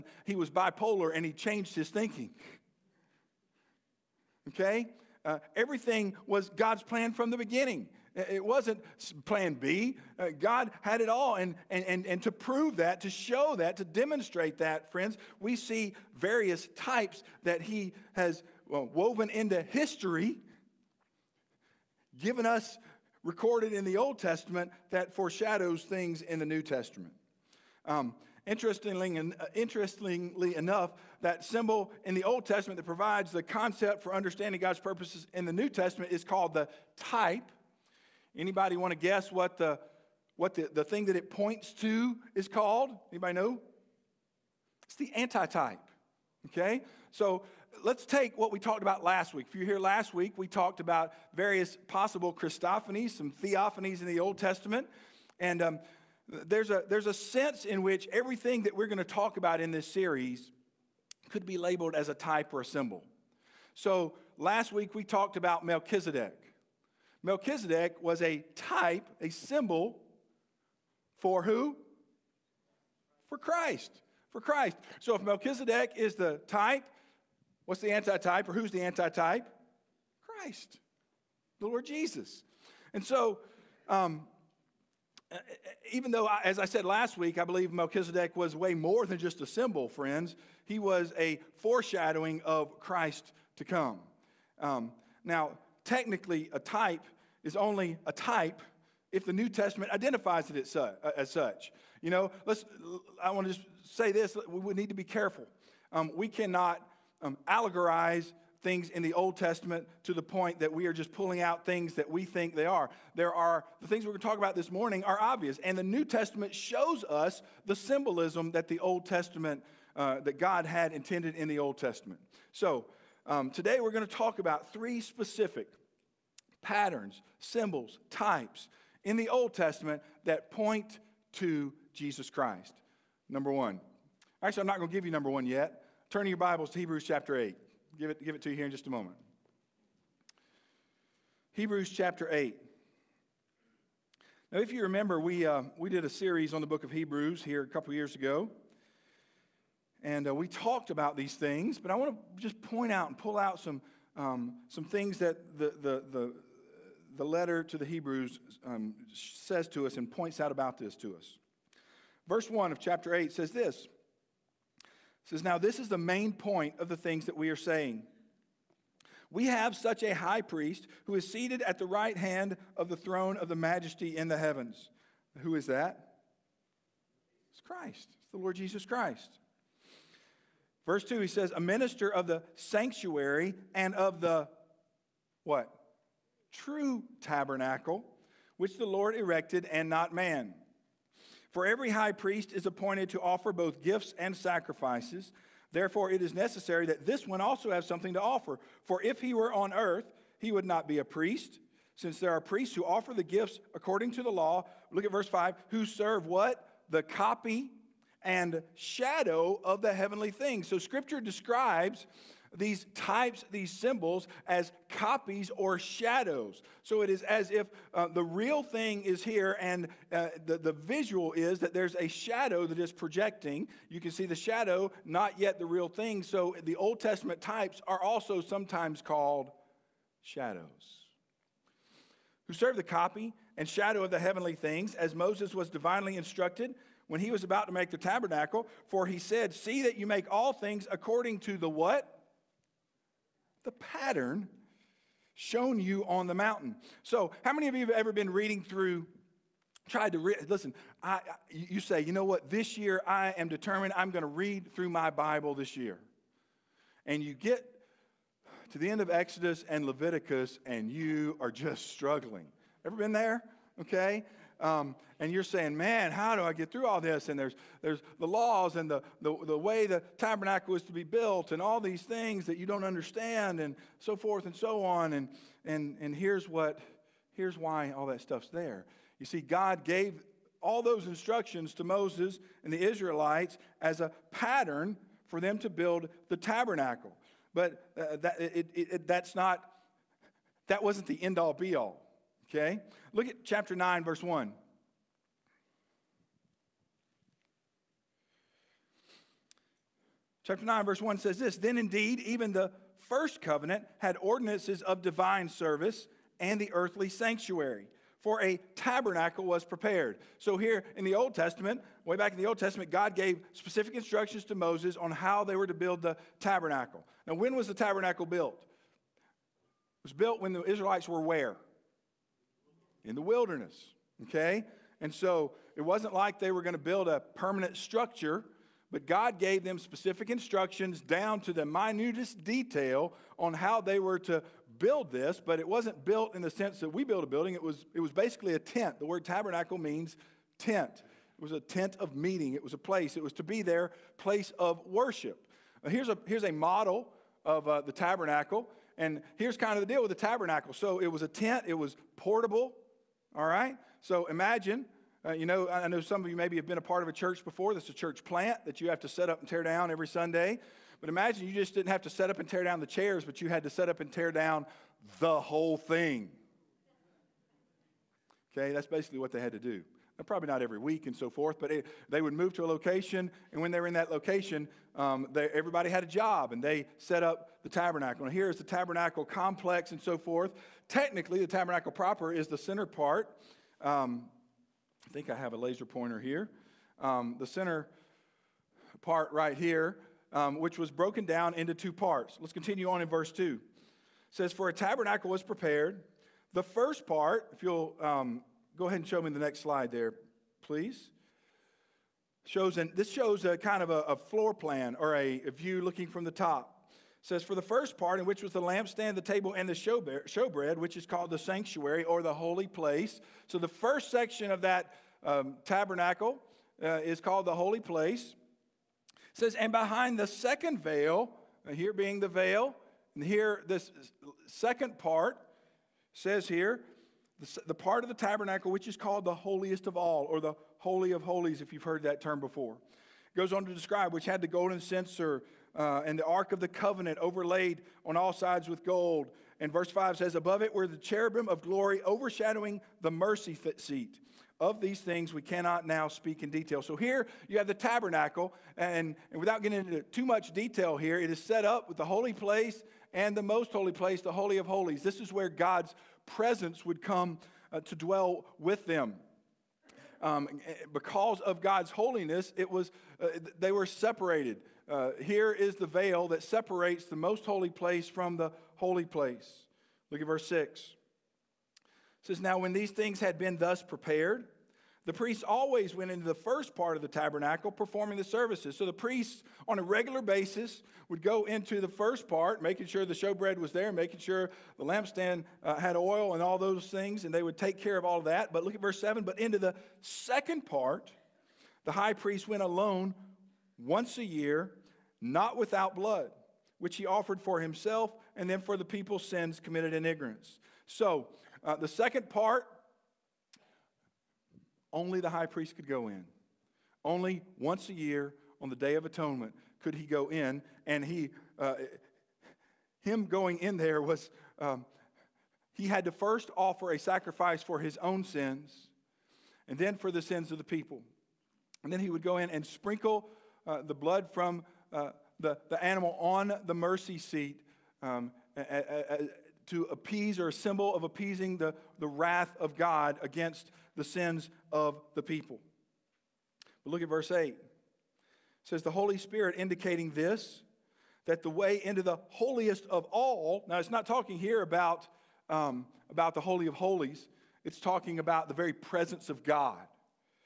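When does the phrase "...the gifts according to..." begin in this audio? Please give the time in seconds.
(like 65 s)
203 s.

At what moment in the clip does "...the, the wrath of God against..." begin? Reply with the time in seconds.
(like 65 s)
531 s.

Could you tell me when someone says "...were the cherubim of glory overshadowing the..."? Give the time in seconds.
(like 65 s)
440 s.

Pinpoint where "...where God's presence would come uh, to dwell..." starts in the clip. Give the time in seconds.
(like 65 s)
455 s.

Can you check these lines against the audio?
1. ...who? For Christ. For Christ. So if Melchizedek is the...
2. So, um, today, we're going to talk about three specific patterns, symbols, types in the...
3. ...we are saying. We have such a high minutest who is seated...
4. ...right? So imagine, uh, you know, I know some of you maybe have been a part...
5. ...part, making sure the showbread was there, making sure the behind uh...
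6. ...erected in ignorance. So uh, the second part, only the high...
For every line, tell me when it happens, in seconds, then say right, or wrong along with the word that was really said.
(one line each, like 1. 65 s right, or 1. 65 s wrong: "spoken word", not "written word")
1. 71 s right
2. 122 s right
3. 167 s wrong: "priest", not "minutest"
4. 353 s right
5. 482 s wrong: "lampstand", not "behind"
6. 499 s wrong: "committed", not "erected".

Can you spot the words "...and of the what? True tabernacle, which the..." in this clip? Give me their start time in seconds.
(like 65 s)
183 s.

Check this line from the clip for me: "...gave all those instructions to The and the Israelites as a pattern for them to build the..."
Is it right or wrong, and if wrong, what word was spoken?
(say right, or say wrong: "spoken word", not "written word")
wrong: "Moses", not "The".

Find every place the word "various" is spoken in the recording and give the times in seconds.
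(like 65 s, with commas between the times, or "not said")
16 s, 51 s.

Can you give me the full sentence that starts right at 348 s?
And here's kind of the deal with the tabernacle.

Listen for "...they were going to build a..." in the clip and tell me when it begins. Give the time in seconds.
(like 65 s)
326 s.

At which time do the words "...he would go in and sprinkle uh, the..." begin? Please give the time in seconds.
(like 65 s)
521 s.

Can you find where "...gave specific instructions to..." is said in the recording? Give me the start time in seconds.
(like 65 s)
313 s.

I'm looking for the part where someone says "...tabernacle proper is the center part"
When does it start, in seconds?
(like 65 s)
381 s.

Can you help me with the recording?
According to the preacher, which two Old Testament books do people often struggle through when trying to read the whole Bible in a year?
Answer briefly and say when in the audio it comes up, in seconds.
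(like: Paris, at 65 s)
Exodus and Leviticus, at 259 s.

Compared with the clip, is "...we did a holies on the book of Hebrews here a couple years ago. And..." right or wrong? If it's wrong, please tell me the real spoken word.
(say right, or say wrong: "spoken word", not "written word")
wrong: "series", not "holies".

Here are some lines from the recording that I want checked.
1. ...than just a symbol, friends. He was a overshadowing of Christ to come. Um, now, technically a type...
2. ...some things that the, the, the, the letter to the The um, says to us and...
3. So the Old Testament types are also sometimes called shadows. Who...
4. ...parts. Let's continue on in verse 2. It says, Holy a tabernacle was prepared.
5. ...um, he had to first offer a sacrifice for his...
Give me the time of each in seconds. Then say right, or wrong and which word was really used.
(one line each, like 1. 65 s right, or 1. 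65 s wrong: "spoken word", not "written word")
1. 89 s wrong: "foreshadowing", not "overshadowing"
2. 154 s wrong: "Hebrews", not "The"
3. 226 s right
4. 391 s wrong: "For", not "Holy"
5. 514 s right.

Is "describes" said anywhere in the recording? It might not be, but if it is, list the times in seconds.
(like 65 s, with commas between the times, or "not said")
211 s, 433 s.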